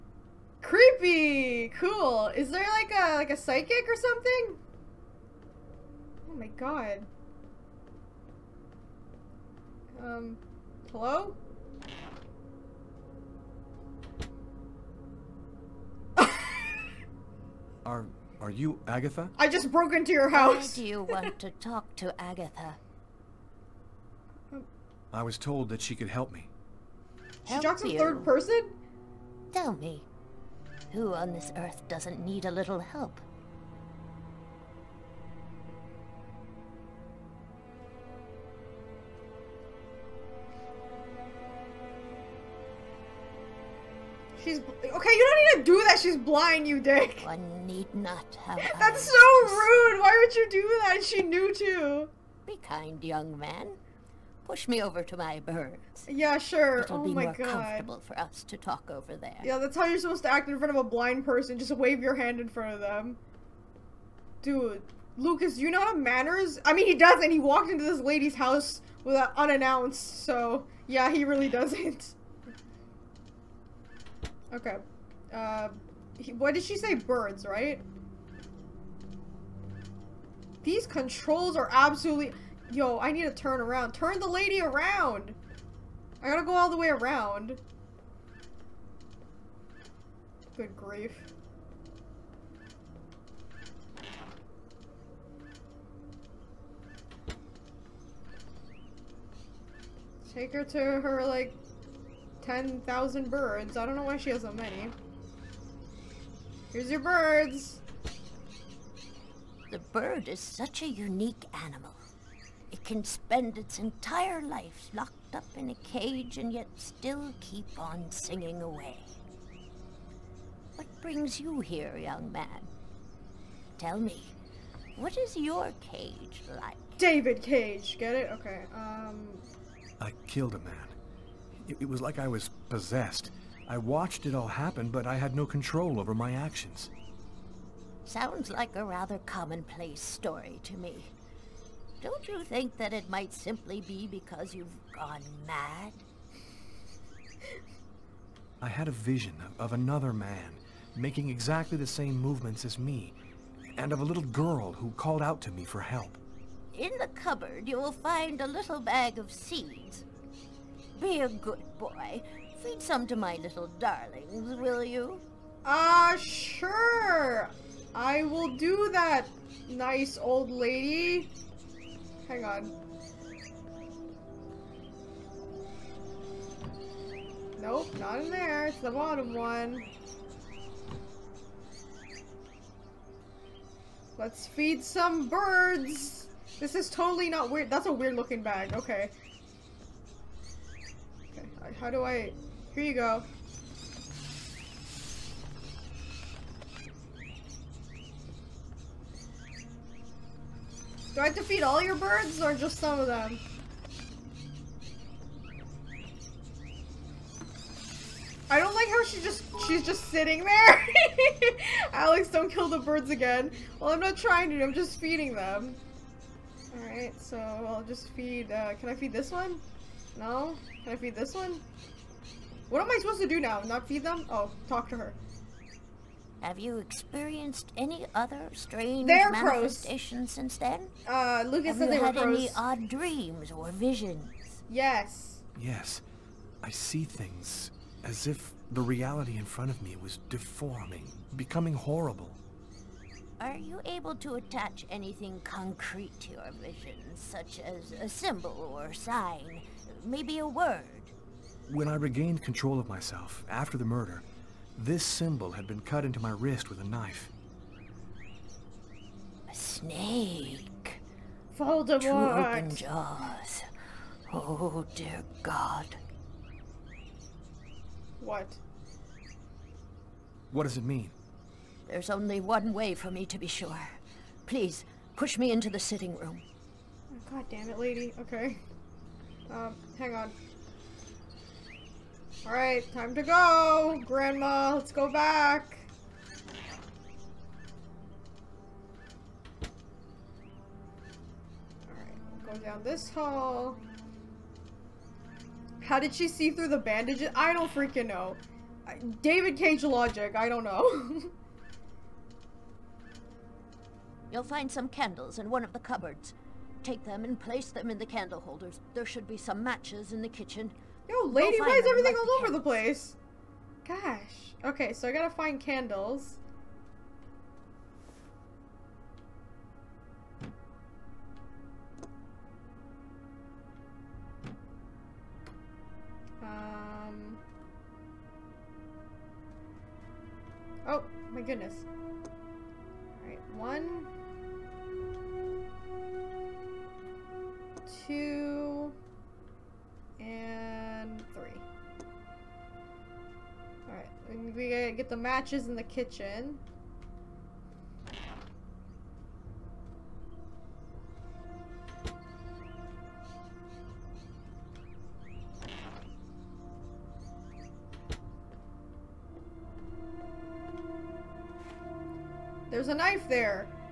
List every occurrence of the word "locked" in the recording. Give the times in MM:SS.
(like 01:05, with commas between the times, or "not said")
01:54.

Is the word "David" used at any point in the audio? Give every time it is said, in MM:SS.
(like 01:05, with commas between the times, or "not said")
02:06, 04:59.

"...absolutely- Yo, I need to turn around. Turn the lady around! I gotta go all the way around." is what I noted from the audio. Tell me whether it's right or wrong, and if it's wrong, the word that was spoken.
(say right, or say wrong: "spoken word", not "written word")
right.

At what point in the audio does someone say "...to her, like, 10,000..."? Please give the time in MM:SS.
01:40.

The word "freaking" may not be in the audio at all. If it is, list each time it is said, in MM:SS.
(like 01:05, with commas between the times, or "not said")
04:57.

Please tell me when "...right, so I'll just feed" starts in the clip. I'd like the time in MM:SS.
03:36.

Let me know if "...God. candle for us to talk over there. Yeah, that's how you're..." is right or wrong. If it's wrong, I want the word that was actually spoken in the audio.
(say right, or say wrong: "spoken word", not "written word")
wrong: "comfortable", not "candle".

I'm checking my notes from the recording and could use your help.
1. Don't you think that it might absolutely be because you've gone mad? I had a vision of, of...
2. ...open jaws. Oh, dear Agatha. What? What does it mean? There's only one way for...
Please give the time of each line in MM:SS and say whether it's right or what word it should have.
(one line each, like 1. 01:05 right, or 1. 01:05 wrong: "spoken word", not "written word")
1. 02:22 wrong: "simply", not "absolutely"
2. 04:22 wrong: "God", not "Agatha".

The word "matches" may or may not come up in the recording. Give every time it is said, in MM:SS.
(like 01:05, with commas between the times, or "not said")
05:09, 05:45.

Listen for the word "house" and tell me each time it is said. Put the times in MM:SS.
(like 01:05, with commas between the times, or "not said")
00:20, 01:08.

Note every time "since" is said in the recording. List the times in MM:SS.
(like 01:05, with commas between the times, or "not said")
03:50.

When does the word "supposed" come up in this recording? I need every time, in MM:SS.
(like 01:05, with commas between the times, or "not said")
00:59, 03:43.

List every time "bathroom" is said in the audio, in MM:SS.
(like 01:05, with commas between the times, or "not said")
not said.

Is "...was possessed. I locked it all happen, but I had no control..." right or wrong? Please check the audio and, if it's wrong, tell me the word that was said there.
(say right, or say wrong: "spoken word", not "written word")
wrong: "watched", not "locked".